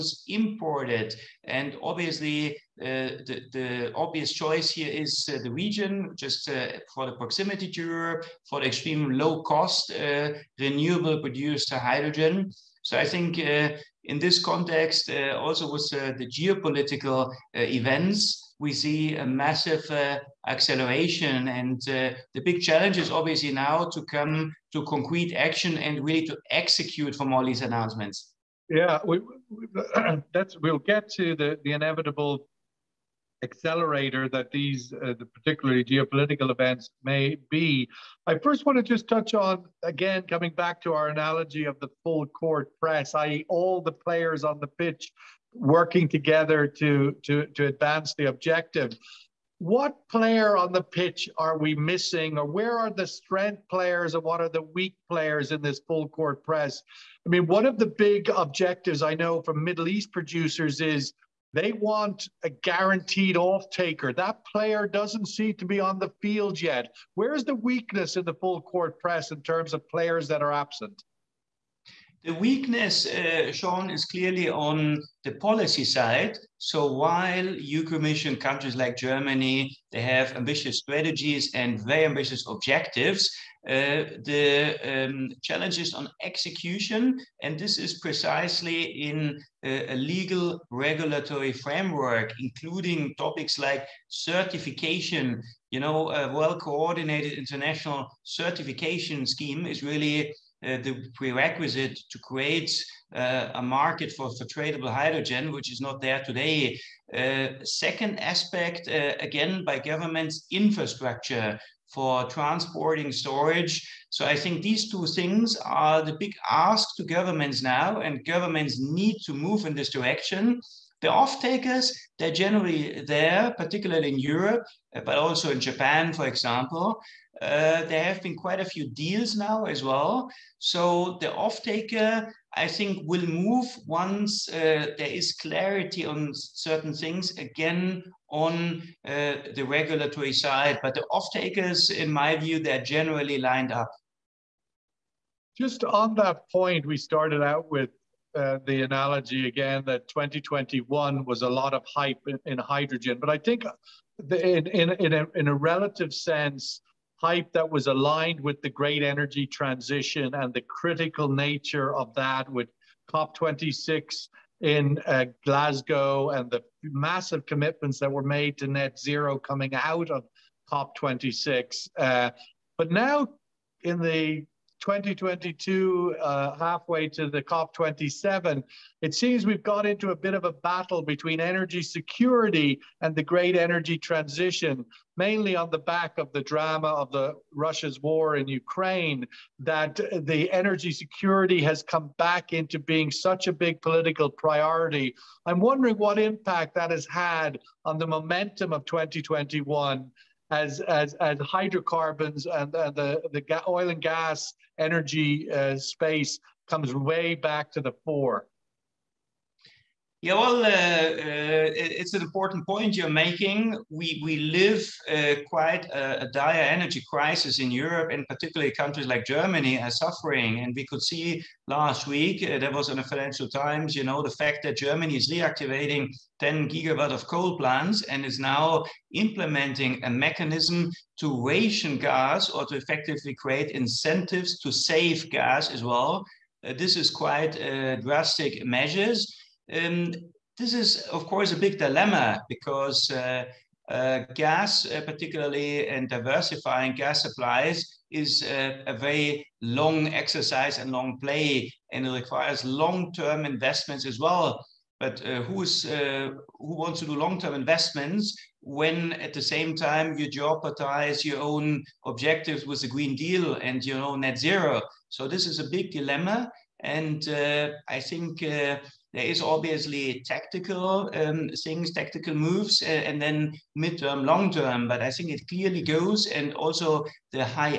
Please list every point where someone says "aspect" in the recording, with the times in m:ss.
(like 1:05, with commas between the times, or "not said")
1:48.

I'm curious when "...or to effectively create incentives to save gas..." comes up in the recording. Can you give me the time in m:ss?
3:52.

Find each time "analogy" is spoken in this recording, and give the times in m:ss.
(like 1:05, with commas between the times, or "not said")
0:41, 2:28.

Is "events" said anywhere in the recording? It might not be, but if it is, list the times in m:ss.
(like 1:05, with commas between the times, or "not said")
0:17, 0:36.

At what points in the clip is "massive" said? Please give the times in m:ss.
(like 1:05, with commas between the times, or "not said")
0:19, 2:46.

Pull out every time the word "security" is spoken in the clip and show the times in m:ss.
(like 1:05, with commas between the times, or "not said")
3:01, 3:10.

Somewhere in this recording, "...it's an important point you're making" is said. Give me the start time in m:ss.
3:32.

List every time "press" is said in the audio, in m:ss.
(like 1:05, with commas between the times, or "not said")
0:42, 0:56, 1:08.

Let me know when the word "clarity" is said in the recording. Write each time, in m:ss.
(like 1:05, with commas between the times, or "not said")
2:15.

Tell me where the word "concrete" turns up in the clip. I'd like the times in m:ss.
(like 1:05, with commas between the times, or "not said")
0:24.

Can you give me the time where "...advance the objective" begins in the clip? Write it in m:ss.
0:47.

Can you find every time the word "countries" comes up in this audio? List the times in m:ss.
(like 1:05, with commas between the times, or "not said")
1:18, 3:38.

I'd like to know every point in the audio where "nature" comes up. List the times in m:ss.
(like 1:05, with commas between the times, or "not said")
2:41.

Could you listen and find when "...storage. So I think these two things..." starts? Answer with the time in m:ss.
1:53.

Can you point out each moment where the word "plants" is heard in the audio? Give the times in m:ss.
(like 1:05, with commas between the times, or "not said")
3:47.